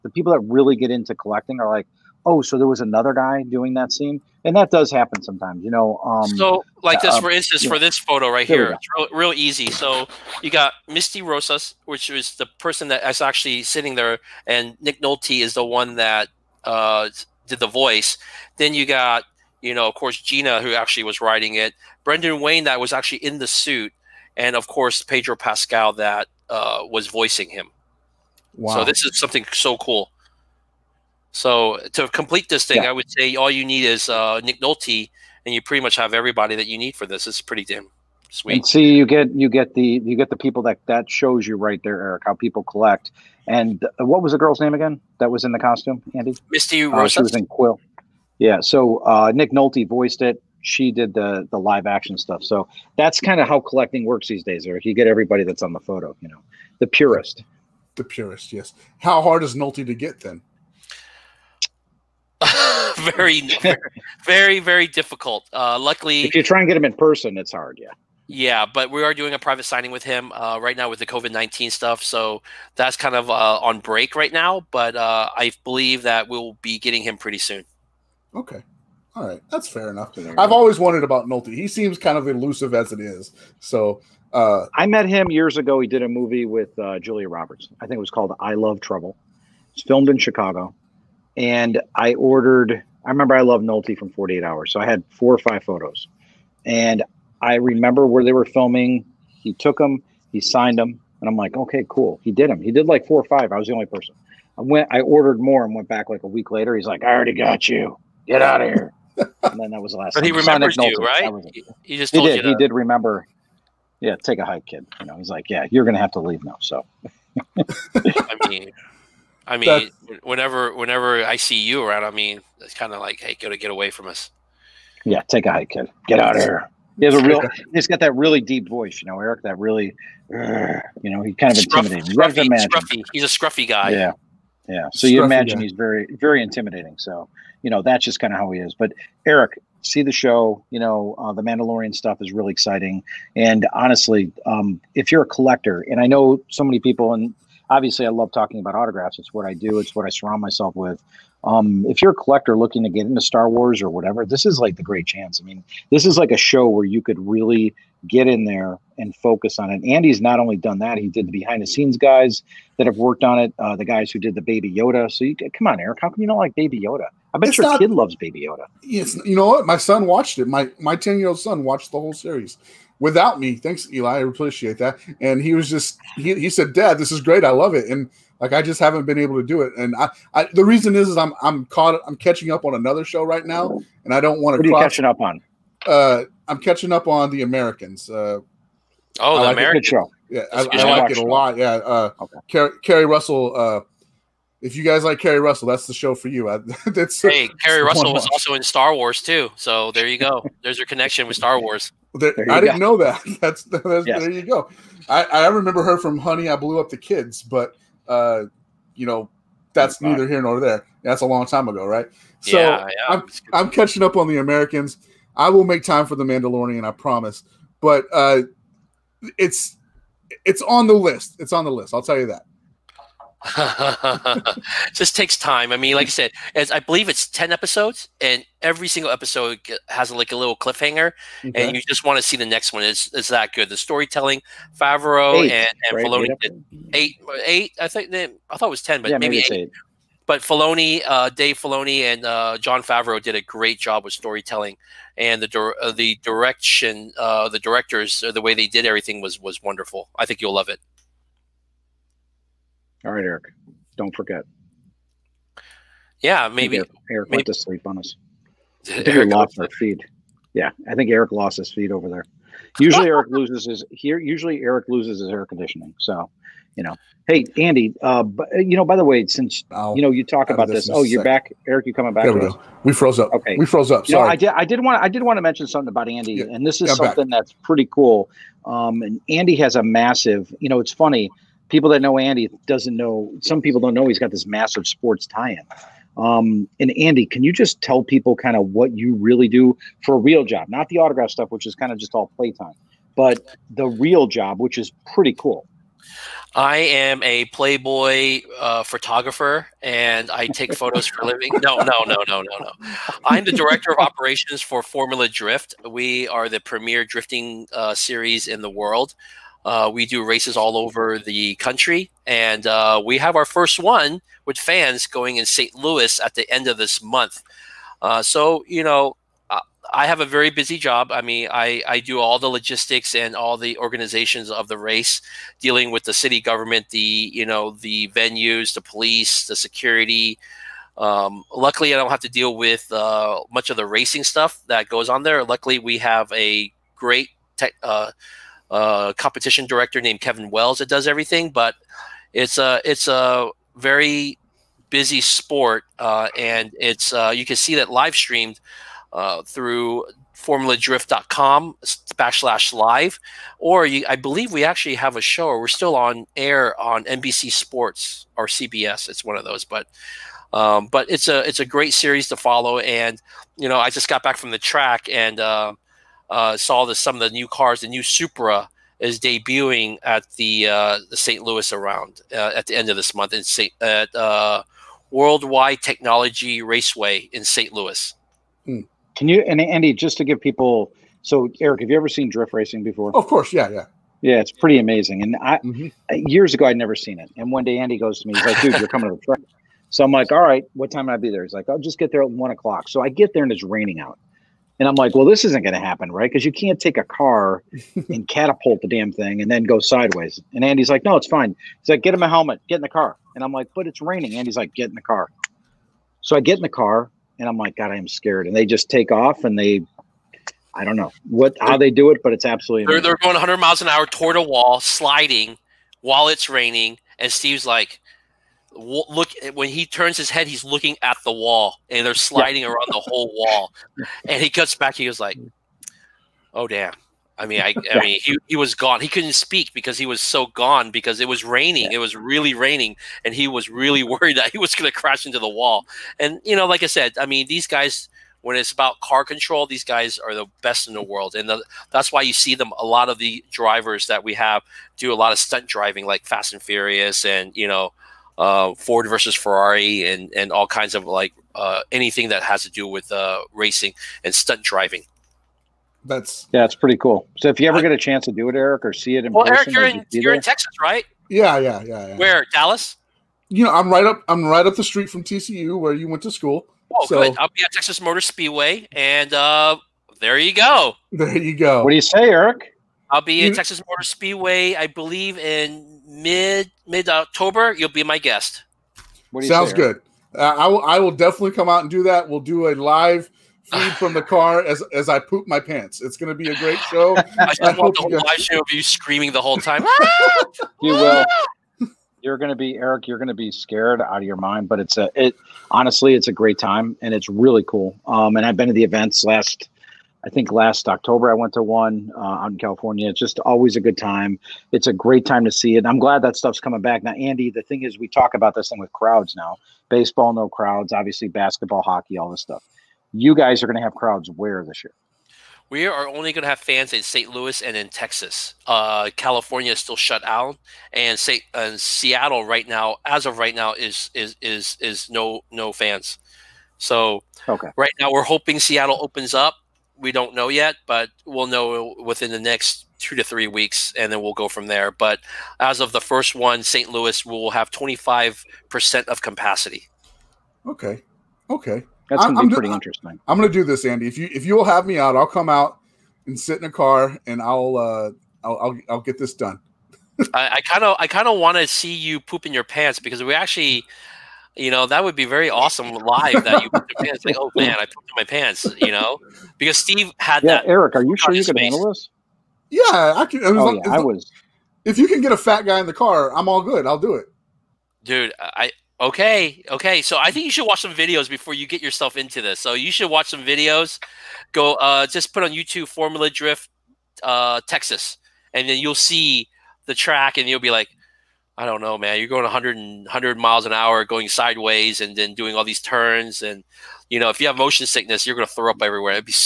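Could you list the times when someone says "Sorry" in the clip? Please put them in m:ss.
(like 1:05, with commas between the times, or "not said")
4:34.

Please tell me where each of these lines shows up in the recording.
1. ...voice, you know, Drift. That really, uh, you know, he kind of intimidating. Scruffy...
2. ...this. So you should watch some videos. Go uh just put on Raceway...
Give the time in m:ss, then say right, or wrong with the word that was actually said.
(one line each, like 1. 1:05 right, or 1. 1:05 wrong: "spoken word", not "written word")
1. 2:08 wrong: "Eric", not "Drift"
2. 9:32 wrong: "YouTube", not "Raceway".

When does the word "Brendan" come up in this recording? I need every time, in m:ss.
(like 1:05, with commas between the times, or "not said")
0:22.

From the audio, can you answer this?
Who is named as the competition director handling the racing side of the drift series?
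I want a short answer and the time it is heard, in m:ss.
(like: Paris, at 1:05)
Kevin Wells, at 5:40.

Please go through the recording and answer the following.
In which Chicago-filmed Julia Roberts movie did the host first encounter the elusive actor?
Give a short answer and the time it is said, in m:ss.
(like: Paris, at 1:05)
I Love Trouble, at 1:28.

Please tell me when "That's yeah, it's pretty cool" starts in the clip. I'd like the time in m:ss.
7:36.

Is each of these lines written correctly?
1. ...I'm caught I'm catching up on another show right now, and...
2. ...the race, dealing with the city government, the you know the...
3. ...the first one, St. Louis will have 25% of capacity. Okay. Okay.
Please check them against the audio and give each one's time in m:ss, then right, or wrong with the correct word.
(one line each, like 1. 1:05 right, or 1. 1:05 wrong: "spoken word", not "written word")
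1. 3:01 right
2. 5:24 right
3. 8:55 right.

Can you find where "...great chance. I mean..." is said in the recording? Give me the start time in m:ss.
2:34.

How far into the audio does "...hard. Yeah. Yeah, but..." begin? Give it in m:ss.
1:07.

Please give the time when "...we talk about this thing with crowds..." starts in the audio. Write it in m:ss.
8:27.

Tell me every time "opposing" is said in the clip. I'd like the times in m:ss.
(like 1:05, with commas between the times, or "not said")
not said.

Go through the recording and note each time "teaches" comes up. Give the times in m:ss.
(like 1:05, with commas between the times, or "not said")
not said.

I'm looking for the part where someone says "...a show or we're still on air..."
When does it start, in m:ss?
5:55.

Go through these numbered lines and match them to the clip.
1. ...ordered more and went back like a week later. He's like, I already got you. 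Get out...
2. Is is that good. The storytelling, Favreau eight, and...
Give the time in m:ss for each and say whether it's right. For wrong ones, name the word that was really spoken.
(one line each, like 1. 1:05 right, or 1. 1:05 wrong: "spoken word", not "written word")
1. 1:45 right
2. 3:52 right.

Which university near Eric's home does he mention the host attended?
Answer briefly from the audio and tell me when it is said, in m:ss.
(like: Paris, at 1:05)
TCU, at 7:45.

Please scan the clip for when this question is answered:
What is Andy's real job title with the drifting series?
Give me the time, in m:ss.
5:03.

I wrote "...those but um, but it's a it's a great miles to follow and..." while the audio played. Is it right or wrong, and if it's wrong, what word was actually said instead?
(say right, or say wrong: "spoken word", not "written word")
wrong: "series", not "miles".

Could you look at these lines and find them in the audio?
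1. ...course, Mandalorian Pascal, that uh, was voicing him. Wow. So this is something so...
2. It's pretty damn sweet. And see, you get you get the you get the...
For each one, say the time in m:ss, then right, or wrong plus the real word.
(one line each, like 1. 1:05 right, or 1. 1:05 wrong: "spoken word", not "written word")
1. 0:24 wrong: "Pedro", not "Mandalorian"
2. 0:37 right.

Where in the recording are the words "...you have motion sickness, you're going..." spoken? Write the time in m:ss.
9:47.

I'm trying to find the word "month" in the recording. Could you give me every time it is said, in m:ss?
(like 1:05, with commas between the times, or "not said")
5:17, 6:13.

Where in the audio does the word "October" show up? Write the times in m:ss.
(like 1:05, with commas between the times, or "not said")
7:57, 8:20.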